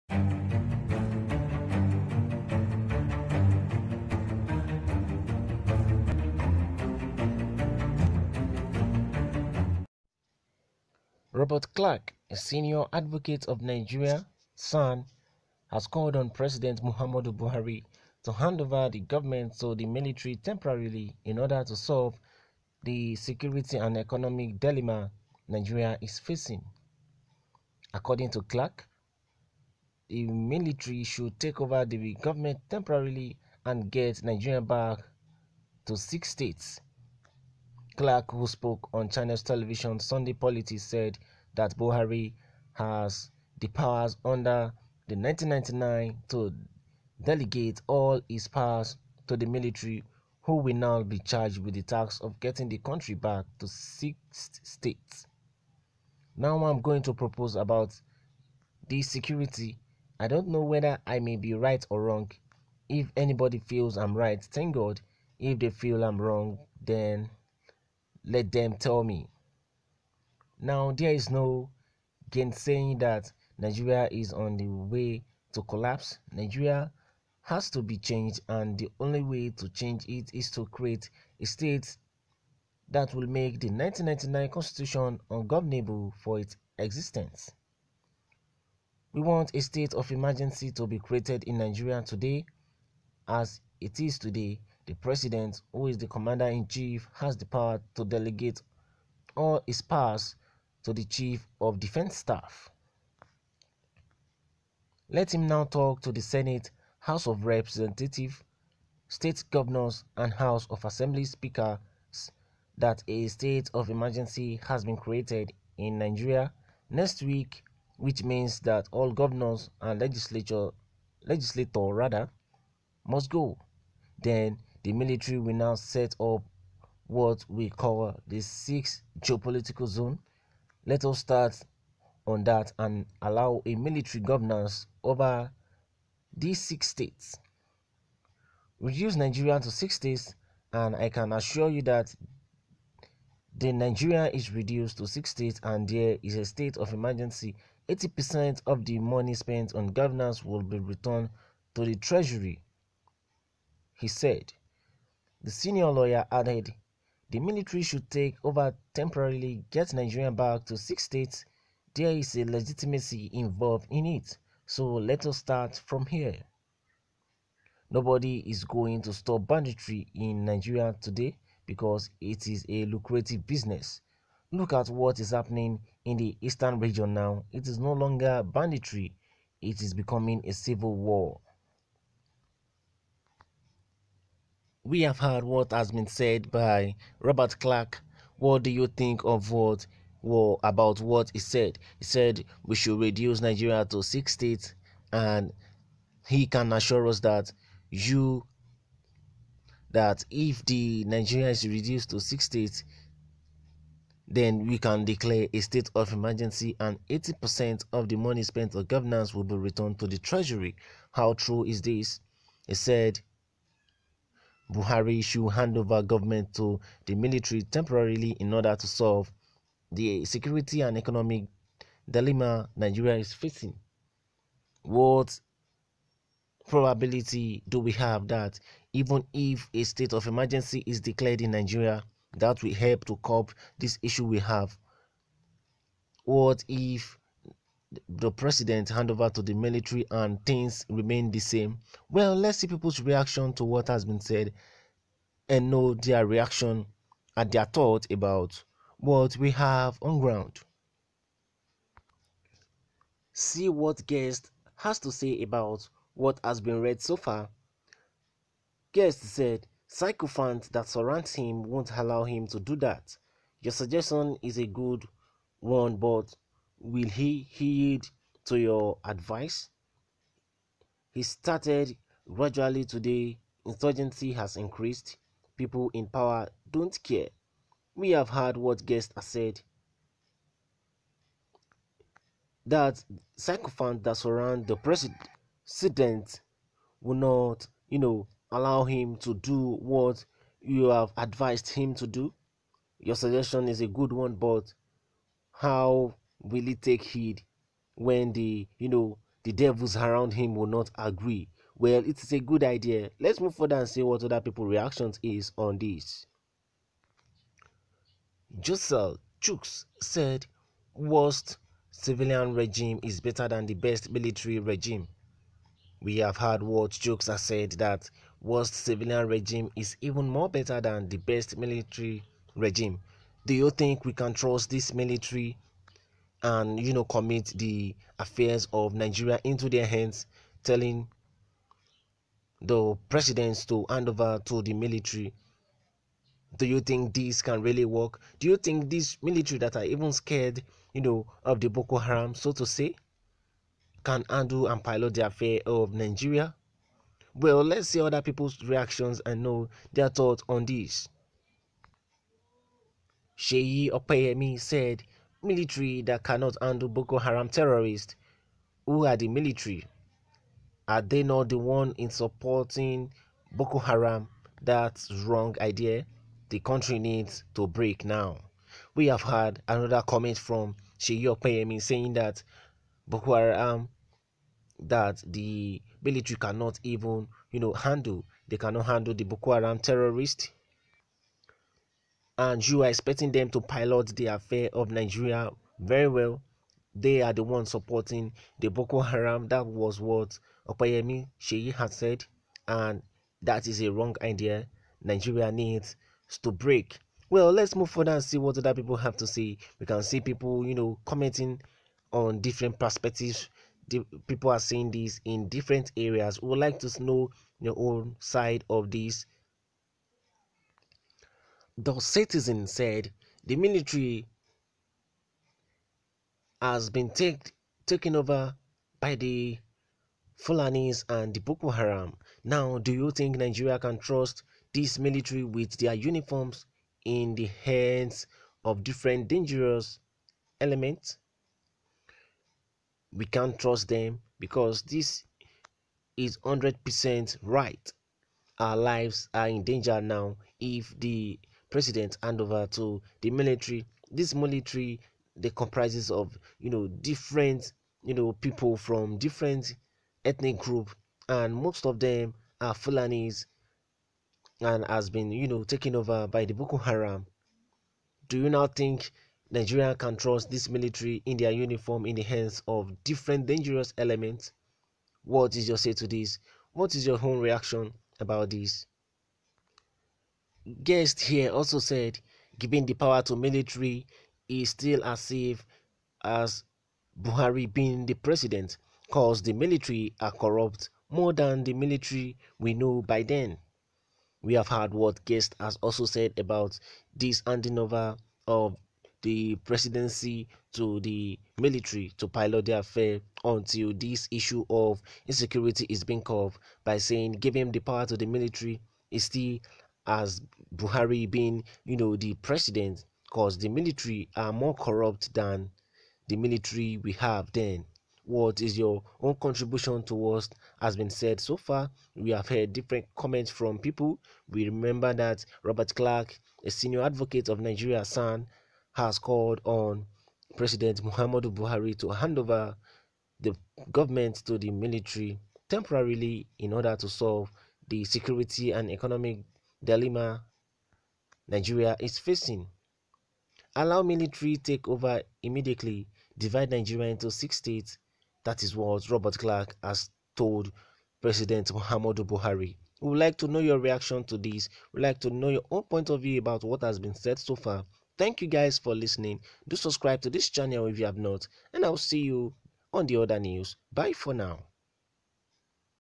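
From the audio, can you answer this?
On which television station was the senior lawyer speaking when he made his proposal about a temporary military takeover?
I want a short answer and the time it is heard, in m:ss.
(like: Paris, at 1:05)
Channels Television, at 0:39.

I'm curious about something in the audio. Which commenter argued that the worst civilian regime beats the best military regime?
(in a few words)
Josel Chooks.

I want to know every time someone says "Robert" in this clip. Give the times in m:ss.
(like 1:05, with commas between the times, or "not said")
0:11, 3:07, 8:35, 8:59.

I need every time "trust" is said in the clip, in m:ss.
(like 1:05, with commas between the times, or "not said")
5:24, 7:03, 7:13, 7:40.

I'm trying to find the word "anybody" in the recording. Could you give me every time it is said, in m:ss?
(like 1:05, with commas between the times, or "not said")
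1:03.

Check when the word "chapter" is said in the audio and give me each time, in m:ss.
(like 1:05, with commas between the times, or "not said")
not said.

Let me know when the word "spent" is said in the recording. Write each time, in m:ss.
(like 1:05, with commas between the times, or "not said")
2:29, 3:28.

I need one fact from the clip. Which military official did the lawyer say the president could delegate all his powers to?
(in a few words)
Chief of Defense Staff.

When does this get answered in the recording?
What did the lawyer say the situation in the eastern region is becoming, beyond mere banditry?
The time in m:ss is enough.
3:00.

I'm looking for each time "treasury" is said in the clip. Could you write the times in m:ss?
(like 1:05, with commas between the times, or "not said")
2:31, 3:30.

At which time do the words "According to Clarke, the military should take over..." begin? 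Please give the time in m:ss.
0:27.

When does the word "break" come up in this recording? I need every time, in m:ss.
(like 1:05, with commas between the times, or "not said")
6:07, 6:36.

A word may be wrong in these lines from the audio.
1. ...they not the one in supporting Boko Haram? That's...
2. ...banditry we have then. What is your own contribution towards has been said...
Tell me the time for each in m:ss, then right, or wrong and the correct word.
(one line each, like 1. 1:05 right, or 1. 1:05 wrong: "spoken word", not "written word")
1. 6:01 right
2. 8:26 wrong: "military", not "banditry".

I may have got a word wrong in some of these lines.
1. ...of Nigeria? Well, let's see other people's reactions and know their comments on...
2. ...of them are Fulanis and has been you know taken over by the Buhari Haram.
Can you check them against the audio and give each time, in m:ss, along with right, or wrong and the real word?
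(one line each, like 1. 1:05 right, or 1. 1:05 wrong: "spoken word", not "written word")
1. 5:45 wrong: "thoughts", not "comments"
2. 7:31 wrong: "Boko", not "Buhari".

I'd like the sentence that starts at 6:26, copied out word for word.
They are the ones supporting the Boko Haram.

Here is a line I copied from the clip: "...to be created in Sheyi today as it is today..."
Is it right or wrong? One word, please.
wrong.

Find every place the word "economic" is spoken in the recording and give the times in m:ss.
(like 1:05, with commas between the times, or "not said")
0:23, 3:40, 8:48.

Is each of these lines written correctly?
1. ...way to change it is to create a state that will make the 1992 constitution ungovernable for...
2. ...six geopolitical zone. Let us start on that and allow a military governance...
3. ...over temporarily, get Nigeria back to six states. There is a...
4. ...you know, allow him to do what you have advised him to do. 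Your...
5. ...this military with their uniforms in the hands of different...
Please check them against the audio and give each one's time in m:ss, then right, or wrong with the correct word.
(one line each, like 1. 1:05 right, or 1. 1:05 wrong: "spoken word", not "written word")
1. 1:19 wrong: "1999", not "1992"
2. 2:08 right
3. 2:38 right
4. 4:47 right
5. 7:04 right.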